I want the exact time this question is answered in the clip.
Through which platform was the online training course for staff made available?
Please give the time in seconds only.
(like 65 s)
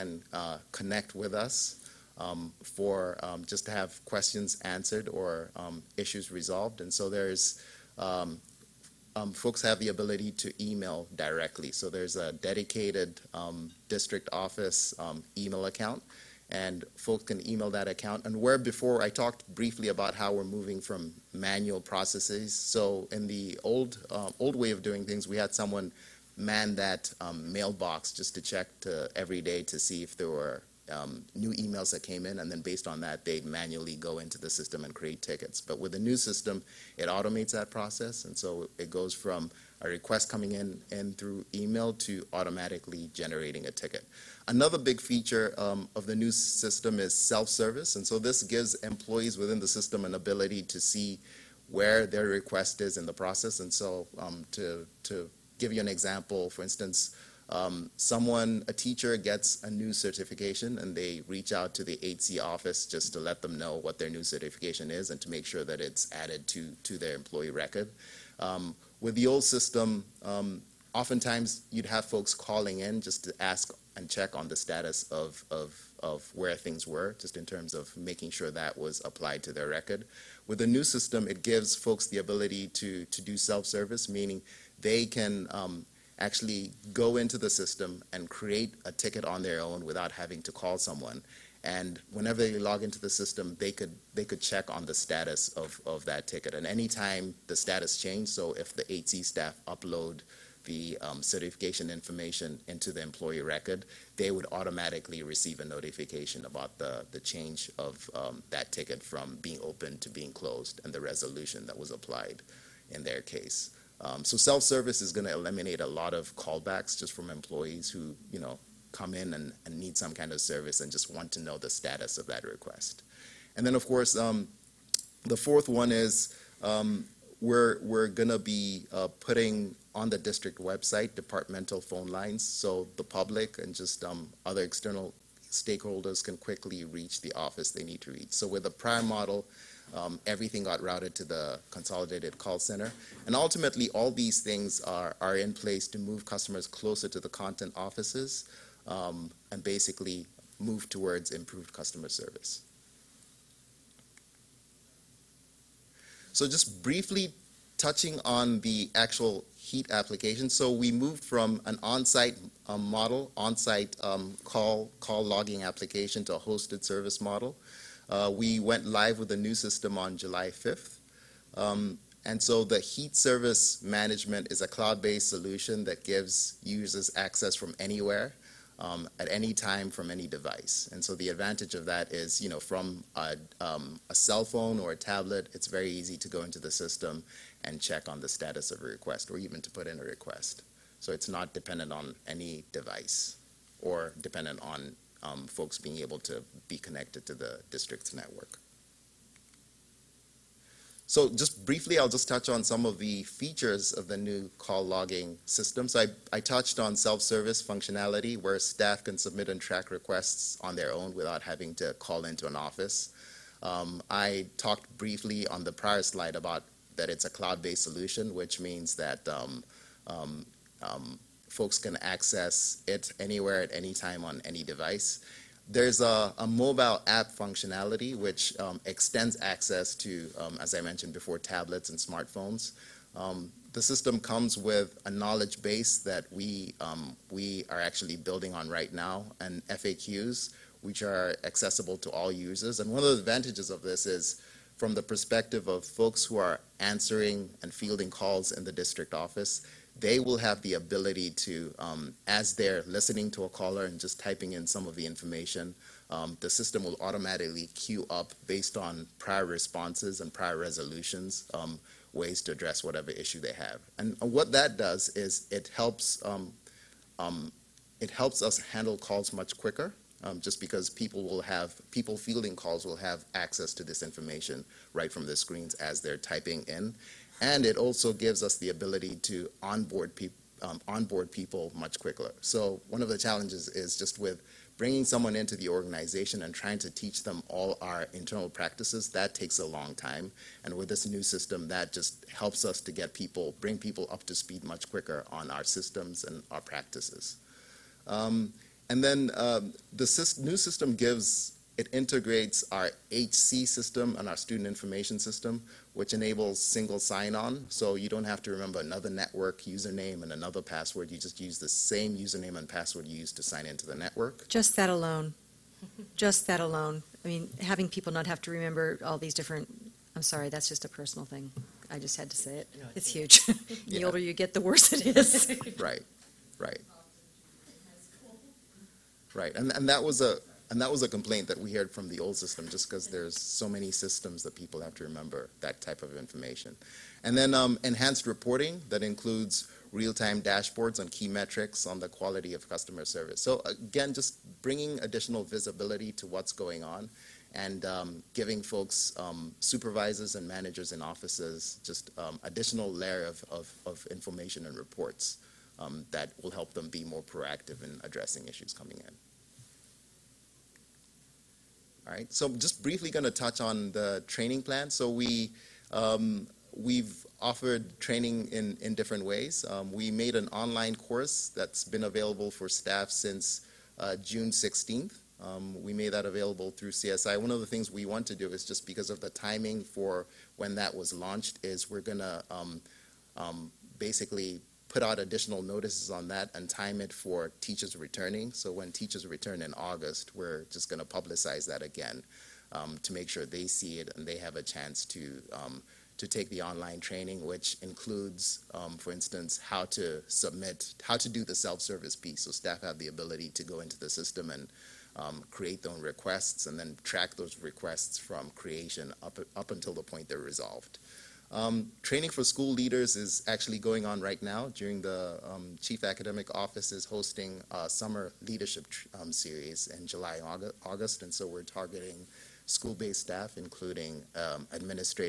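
376 s.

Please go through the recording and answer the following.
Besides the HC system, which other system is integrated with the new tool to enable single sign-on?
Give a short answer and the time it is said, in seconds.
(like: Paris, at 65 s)
Student information system, at 304 s.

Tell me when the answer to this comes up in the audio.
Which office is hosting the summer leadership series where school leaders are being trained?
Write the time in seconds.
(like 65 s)
415 s.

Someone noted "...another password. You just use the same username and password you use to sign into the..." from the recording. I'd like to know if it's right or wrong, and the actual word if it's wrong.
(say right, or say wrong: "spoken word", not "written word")
right.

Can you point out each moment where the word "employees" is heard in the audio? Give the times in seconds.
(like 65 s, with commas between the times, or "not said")
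48 s, 67 s, 103 s, 117 s.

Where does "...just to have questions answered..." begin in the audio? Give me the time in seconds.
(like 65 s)
3 s.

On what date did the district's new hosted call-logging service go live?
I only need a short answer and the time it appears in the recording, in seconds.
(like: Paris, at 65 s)
July 5, at 170 s.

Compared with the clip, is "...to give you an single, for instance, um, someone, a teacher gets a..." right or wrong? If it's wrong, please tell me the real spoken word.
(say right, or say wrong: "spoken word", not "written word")
wrong: "example", not "single".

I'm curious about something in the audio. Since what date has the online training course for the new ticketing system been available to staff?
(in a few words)
June 16.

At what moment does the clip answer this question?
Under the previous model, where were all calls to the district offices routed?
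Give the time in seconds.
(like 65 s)
141 s.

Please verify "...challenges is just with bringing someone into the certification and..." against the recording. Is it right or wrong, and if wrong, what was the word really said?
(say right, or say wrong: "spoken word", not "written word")
wrong: "organization", not "certification".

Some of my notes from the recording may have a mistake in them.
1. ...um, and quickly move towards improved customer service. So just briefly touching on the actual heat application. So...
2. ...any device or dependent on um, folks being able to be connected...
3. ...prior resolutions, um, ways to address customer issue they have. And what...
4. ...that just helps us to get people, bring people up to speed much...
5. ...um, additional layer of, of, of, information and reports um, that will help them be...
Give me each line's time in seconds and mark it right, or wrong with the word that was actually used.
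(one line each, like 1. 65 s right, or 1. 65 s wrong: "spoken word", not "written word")
1. 148 s wrong: "basically", not "quickly"
2. 192 s right
3. 260 s wrong: "whatever", not "customer"
4. 291 s right
5. 352 s right.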